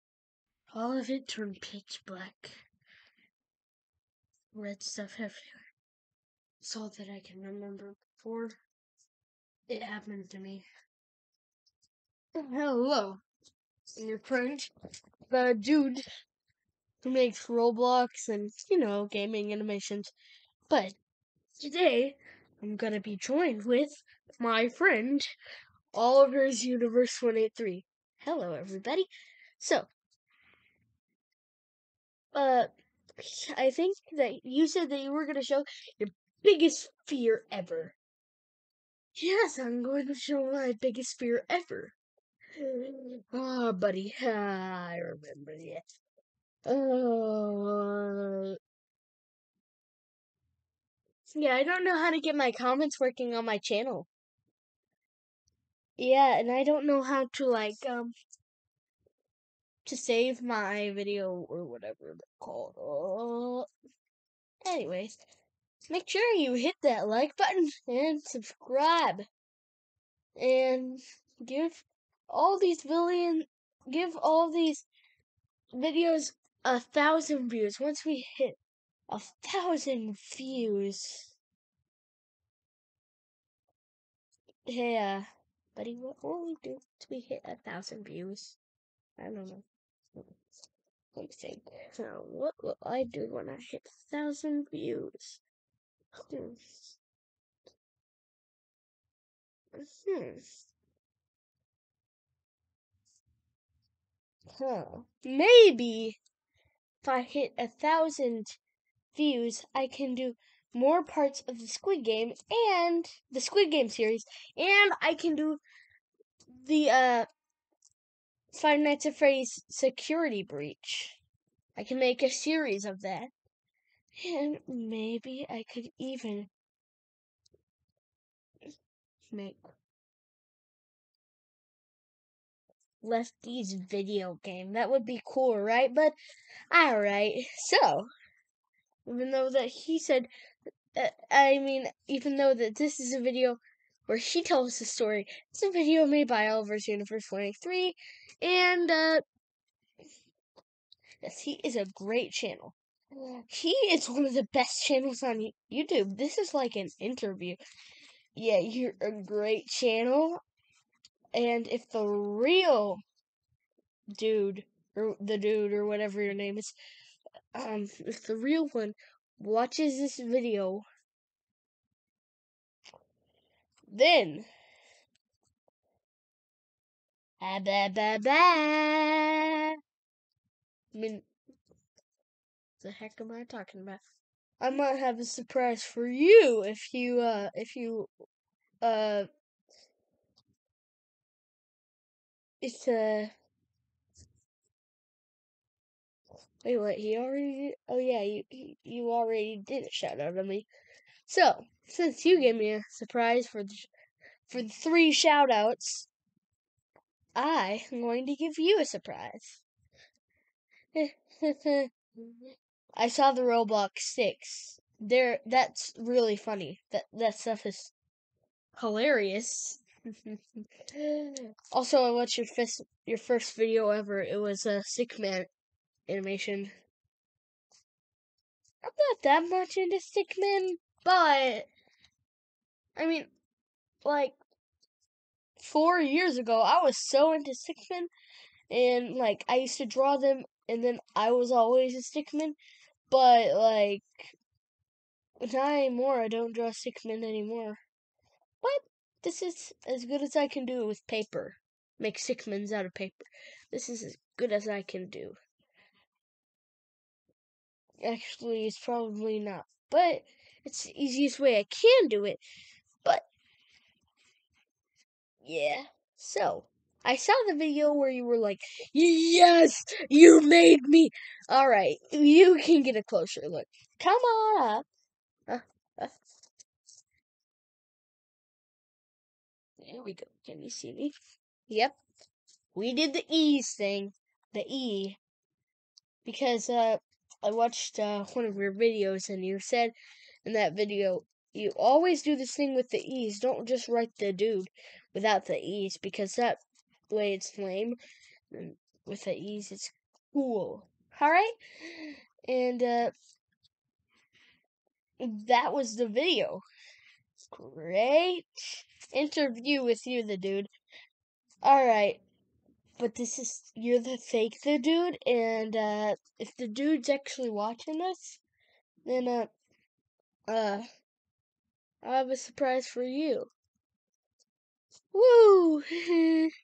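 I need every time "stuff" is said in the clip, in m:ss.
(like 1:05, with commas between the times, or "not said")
0:04, 3:37.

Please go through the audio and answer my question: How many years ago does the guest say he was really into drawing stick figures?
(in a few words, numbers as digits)
4.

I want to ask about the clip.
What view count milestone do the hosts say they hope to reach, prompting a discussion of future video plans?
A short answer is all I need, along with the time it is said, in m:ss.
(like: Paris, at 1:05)
1000, at 1:16.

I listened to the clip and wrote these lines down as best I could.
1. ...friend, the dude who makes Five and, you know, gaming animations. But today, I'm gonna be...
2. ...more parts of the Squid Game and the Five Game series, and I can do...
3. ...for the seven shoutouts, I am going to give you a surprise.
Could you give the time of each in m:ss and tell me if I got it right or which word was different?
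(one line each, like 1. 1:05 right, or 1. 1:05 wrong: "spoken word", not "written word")
1. 0:14 wrong: "Roblox", not "Five"
2. 1:50 wrong: "Squid", not "Five"
3. 3:24 wrong: "three", not "seven".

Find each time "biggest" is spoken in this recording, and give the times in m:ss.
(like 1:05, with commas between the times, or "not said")
0:36, 0:40.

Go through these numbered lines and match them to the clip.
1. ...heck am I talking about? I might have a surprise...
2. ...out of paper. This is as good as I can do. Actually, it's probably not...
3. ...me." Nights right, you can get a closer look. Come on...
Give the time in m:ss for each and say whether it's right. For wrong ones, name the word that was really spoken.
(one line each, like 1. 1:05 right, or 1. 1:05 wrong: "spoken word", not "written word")
1. 3:02 right
2. 4:12 right
3. 4:30 wrong: "All", not "Nights".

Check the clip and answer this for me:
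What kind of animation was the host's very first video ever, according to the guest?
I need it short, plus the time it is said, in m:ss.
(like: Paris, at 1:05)
stickman animation, at 3:44.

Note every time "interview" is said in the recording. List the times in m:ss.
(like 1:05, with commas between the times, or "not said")
2:36, 5:09.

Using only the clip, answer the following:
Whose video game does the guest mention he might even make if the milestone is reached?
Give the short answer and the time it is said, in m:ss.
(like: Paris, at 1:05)
Lefty's, at 2:13.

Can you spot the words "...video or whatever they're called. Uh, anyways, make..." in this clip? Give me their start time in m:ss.
1:00.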